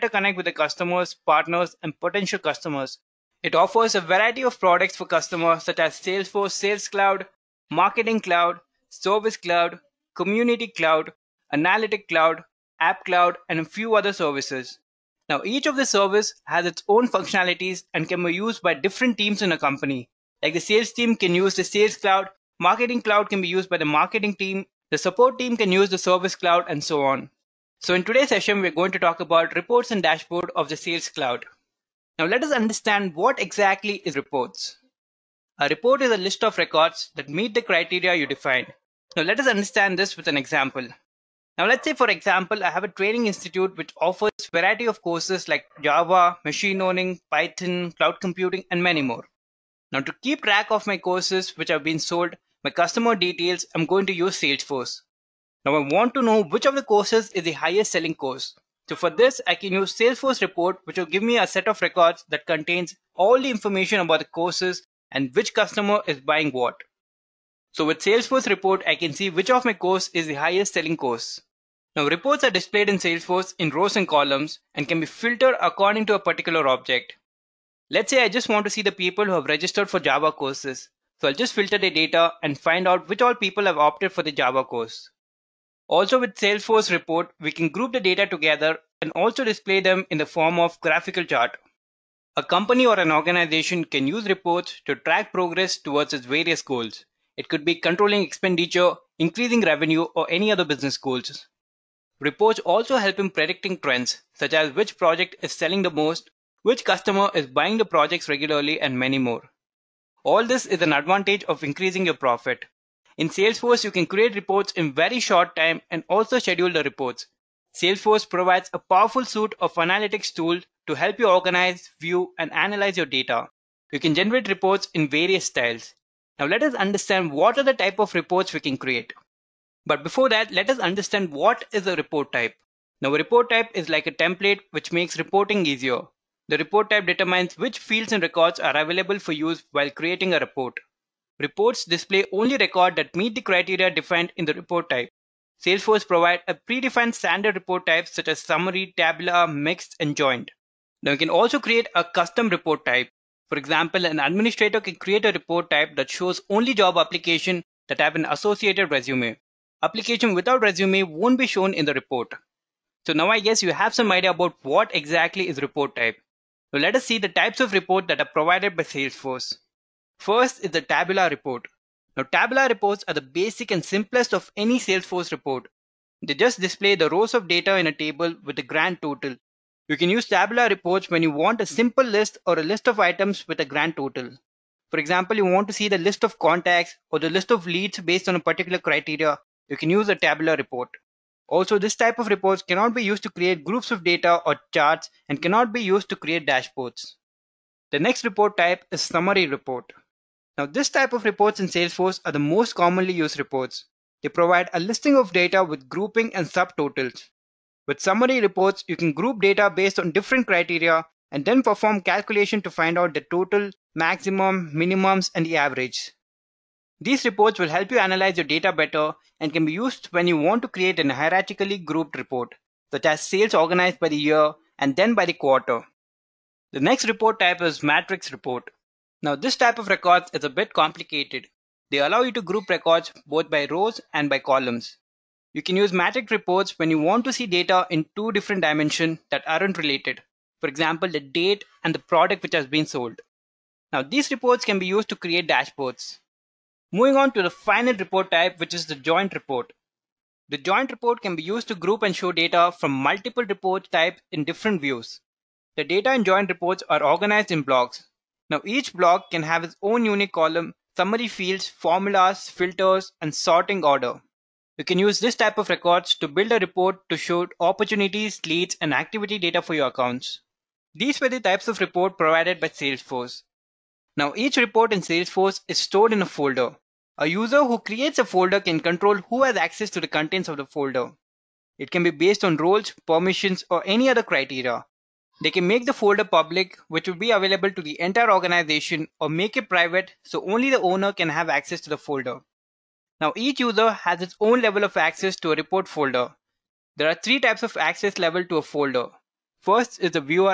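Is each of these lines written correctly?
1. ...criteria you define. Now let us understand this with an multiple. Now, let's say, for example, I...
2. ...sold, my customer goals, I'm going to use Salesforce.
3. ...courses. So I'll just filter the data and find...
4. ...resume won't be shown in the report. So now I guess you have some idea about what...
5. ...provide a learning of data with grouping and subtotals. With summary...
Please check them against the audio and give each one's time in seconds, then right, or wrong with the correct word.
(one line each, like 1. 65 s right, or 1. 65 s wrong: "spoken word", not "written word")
1. 37 s wrong: "example", not "multiple"
2. 51 s wrong: "details", not "goals"
3. 80 s right
4. 160 s right
5. 204 s wrong: "listing", not "learning".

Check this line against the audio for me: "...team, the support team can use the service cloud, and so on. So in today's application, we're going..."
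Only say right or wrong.
wrong.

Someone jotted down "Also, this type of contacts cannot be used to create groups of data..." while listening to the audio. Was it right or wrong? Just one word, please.
wrong.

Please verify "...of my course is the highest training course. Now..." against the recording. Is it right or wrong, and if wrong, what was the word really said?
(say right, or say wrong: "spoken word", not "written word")
wrong: "selling", not "training".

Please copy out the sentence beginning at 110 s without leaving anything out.
All this is an advantage of increasing your profit.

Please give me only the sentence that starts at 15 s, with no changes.
Now, each of the service has its own functionalities and can be used by different teams in a company.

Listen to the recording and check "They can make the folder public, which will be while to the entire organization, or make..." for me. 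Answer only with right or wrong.
wrong.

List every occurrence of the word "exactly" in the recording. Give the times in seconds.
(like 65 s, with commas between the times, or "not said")
33 s, 164 s.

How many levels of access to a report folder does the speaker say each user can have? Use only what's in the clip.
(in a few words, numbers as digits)
3.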